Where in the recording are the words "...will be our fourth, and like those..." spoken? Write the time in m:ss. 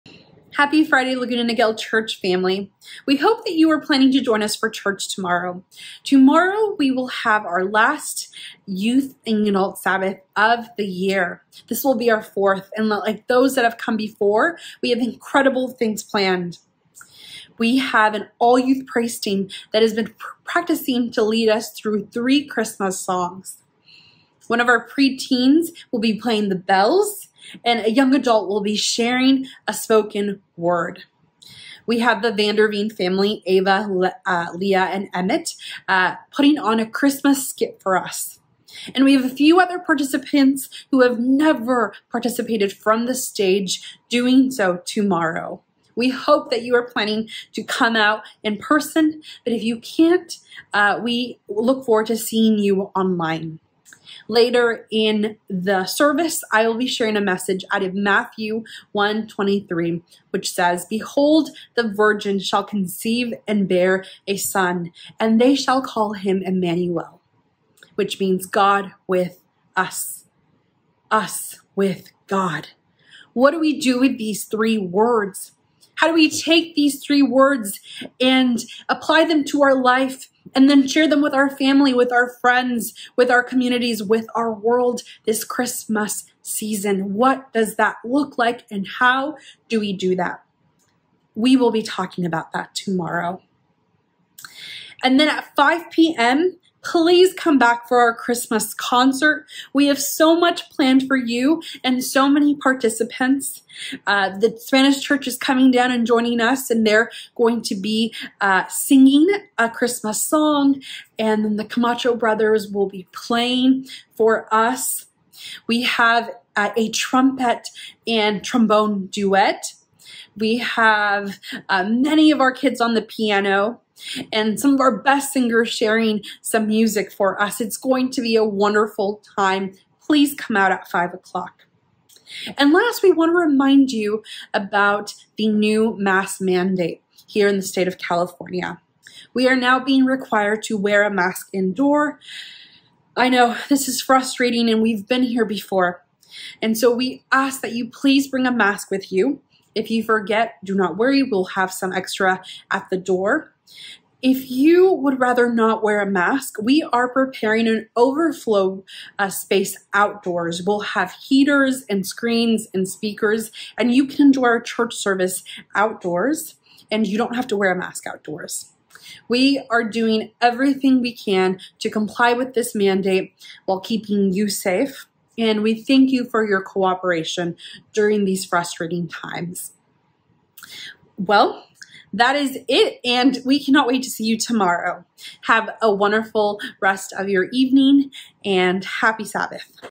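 0:11.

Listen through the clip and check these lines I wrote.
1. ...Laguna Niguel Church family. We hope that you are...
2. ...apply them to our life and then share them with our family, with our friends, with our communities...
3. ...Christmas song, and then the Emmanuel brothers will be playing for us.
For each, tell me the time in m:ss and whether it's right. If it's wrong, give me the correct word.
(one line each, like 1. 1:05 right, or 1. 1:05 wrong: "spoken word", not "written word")
1. 0:01 right
2. 1:18 right
3. 1:49 wrong: "Camacho", not "Emmanuel".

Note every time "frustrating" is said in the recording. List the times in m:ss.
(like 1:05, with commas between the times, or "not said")
2:24, 2:58.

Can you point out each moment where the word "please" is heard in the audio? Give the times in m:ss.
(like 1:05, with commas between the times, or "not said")
1:36, 2:10, 2:27.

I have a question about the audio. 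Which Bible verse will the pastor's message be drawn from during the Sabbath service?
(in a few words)
Matthew 1:23.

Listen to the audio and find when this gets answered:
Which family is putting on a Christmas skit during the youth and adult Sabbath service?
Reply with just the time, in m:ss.
0:32.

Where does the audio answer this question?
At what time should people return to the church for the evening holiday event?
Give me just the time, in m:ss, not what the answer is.
1:35.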